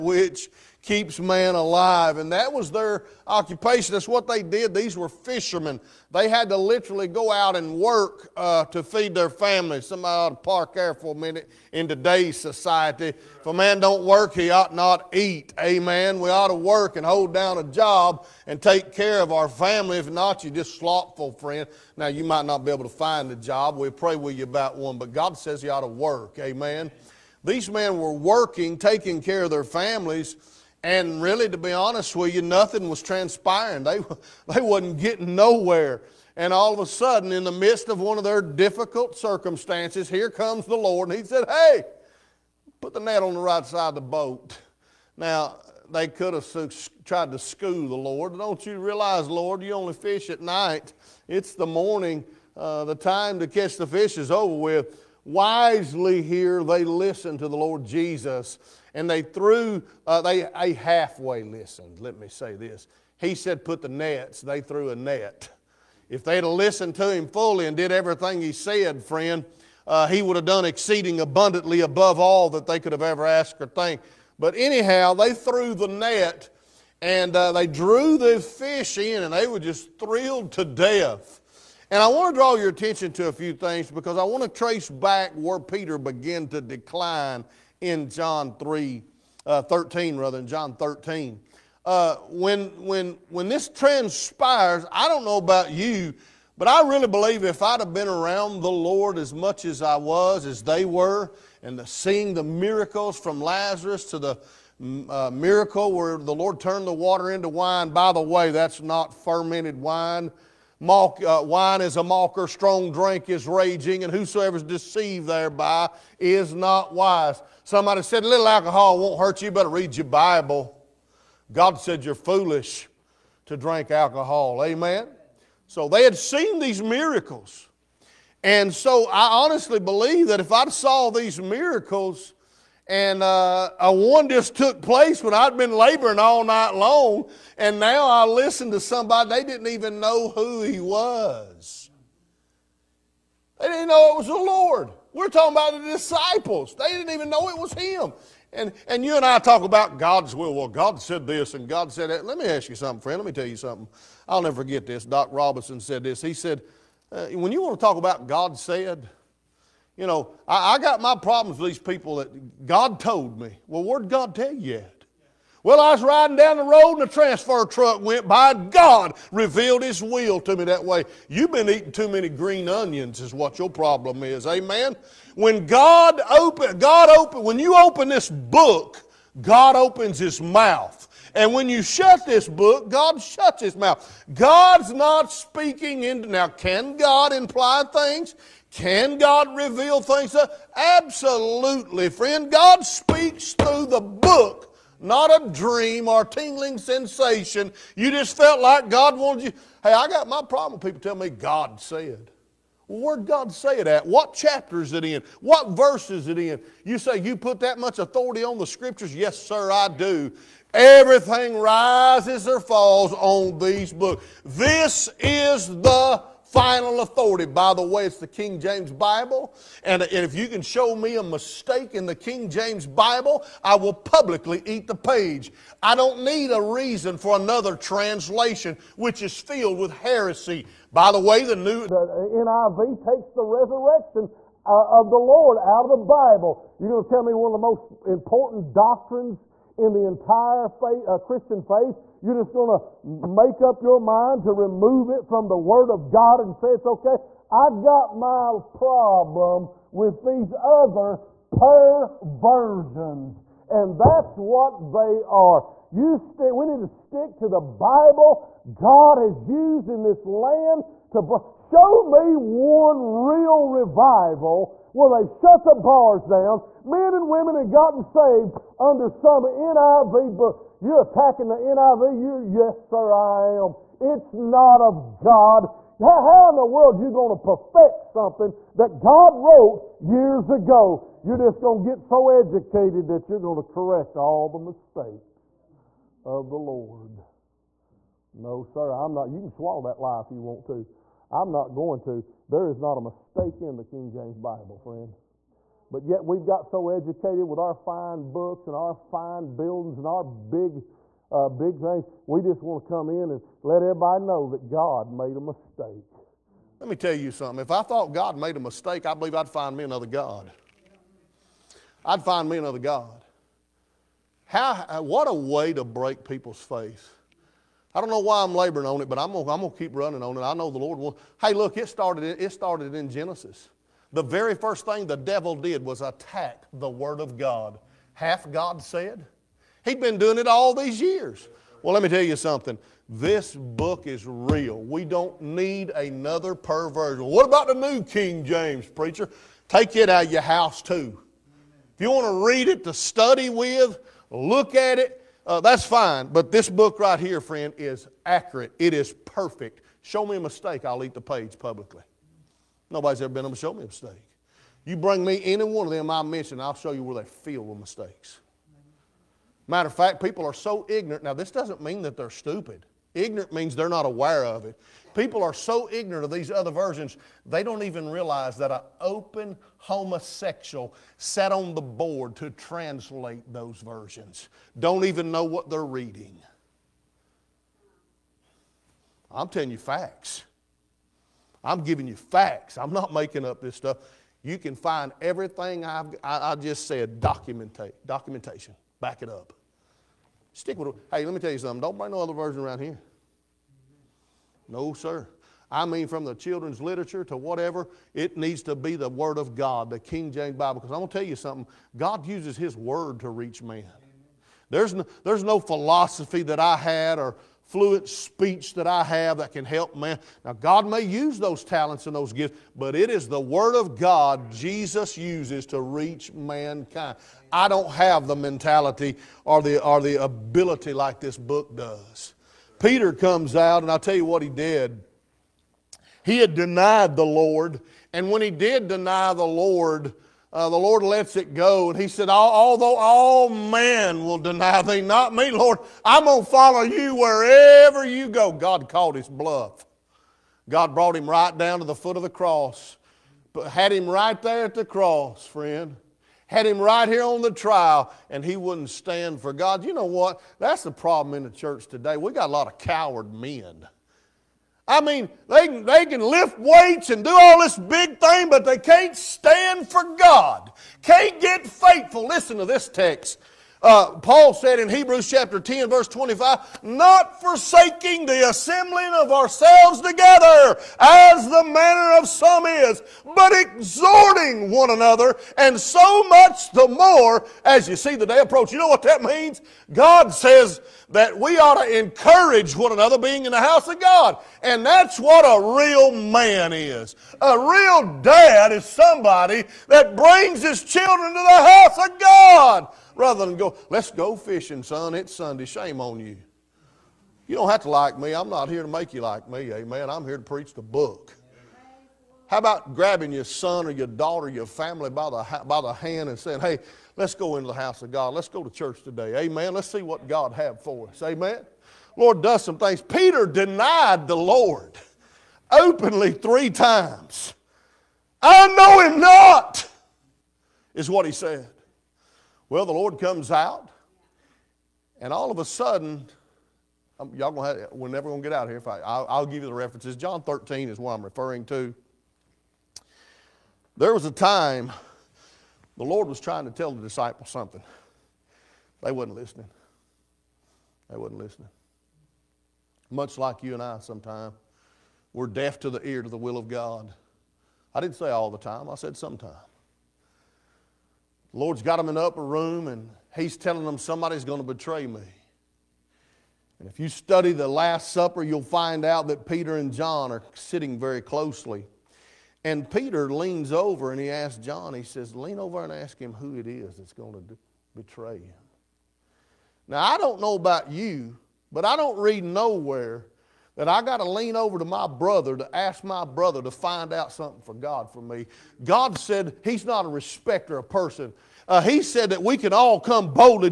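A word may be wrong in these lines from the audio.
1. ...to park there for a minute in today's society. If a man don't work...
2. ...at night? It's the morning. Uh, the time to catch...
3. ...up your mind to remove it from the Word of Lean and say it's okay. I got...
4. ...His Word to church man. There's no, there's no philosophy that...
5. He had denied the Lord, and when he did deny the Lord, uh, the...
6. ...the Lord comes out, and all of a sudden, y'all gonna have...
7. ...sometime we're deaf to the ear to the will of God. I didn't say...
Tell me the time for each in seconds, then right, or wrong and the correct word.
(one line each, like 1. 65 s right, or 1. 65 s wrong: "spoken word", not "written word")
1. 10 s right
2. 50 s right
3. 243 s wrong: "God", not "Lean"
4. 402 s wrong: "reach", not "church"
5. 426 s right
6. 522 s right
7. 544 s right.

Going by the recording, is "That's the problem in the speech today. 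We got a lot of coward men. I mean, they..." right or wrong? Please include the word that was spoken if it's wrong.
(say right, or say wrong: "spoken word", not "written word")
wrong: "church", not "speech".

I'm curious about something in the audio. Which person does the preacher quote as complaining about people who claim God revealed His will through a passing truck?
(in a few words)
Doc Robinson.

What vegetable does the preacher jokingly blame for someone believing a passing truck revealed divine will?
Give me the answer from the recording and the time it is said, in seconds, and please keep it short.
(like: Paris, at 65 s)
green onions, at 172 s.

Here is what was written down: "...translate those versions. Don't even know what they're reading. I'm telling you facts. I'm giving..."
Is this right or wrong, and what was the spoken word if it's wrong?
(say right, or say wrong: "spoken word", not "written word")
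right.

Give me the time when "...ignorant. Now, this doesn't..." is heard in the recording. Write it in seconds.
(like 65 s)
360 s.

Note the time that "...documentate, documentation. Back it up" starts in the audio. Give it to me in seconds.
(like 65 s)
387 s.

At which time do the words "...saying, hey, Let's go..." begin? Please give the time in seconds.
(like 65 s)
506 s.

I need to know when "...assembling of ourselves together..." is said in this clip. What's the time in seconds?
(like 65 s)
468 s.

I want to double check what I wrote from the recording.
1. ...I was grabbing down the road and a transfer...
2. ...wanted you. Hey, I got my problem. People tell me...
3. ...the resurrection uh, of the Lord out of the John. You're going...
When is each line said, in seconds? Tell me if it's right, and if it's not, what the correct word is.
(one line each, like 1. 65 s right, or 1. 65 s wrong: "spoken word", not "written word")
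1. 165 s wrong: "riding", not "grabbing"
2. 199 s right
3. 233 s wrong: "Bible", not "John".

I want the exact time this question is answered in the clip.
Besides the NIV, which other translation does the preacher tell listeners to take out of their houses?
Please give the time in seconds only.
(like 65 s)
337 s.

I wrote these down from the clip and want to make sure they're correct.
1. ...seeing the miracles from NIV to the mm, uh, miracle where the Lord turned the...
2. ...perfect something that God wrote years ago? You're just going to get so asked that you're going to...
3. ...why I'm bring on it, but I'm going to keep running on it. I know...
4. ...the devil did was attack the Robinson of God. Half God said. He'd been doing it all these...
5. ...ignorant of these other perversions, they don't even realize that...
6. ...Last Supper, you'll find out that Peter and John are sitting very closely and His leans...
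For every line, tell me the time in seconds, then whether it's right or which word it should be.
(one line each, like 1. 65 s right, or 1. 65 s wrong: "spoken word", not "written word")
1. 101 s wrong: "Lazarus", not "NIV"
2. 277 s wrong: "educated", not "asked"
3. 318 s wrong: "laboring", not "bring"
4. 325 s wrong: "Word", not "Robinson"
5. 365 s wrong: "versions", not "perversions"
6. 557 s wrong: "Peter", not "His".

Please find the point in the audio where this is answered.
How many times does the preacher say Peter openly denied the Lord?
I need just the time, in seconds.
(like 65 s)
516 s.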